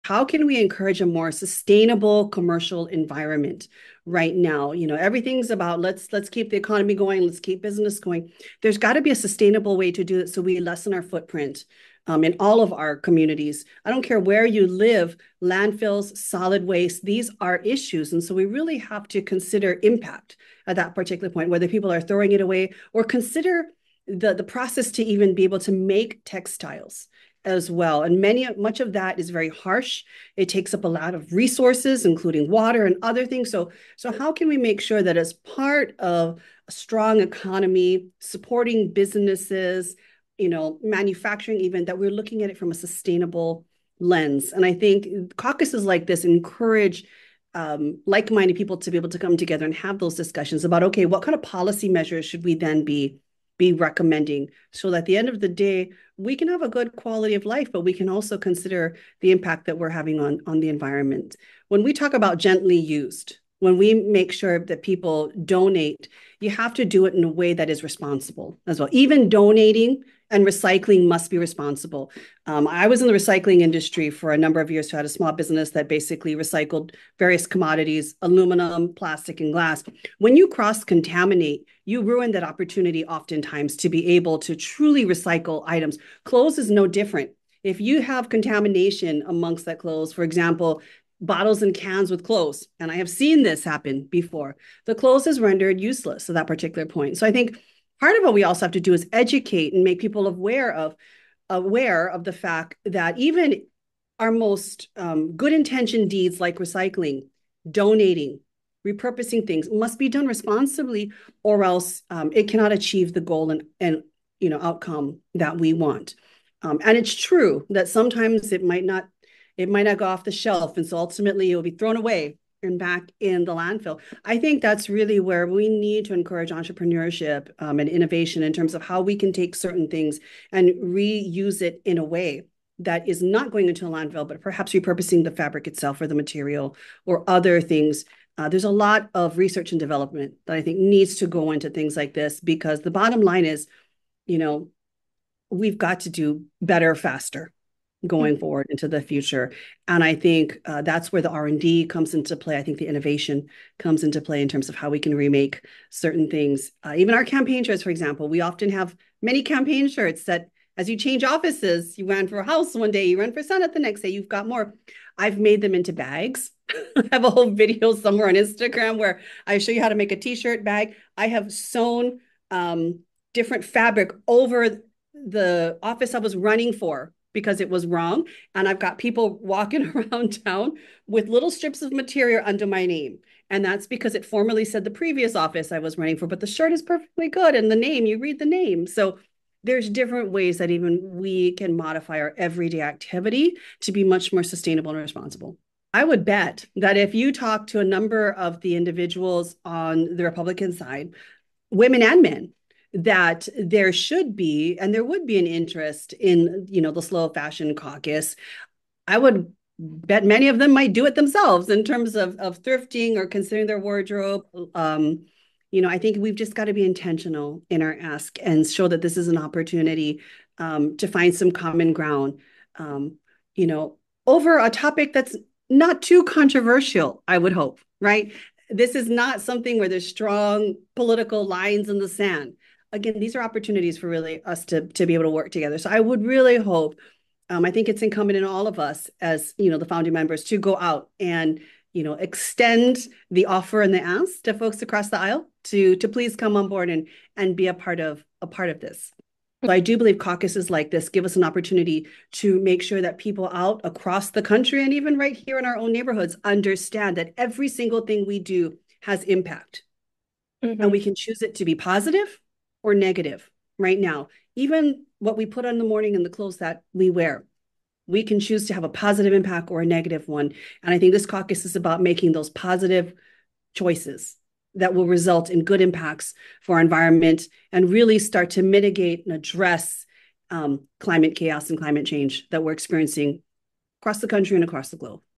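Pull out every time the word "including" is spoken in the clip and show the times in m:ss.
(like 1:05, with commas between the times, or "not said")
0:32.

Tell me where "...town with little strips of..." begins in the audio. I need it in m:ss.
3:00.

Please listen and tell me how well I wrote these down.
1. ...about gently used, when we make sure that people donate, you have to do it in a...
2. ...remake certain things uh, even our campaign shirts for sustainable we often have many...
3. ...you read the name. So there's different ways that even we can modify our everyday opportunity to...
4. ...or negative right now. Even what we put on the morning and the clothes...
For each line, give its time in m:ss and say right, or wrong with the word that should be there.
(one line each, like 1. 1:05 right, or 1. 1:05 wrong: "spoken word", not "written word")
1. 1:02 right
2. 2:35 wrong: "example", not "sustainable"
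3. 3:08 wrong: "activity", not "opportunity"
4. 4:22 right.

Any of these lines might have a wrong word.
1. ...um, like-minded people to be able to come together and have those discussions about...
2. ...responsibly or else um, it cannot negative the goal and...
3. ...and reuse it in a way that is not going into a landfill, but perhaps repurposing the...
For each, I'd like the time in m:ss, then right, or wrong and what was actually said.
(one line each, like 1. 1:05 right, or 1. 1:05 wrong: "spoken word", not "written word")
1. 0:47 right
2. 1:50 wrong: "achieve", not "negative"
3. 2:10 right.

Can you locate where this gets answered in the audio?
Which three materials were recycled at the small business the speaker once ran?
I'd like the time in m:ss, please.
1:18.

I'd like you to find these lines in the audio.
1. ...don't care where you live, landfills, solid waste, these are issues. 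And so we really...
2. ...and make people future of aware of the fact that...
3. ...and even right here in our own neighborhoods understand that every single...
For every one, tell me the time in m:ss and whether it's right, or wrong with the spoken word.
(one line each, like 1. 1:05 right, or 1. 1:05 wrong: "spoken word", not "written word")
1. 0:13 right
2. 1:39 wrong: "aware", not "future"
3. 4:14 right.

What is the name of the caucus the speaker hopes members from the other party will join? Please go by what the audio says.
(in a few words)
Slow fashion caucus.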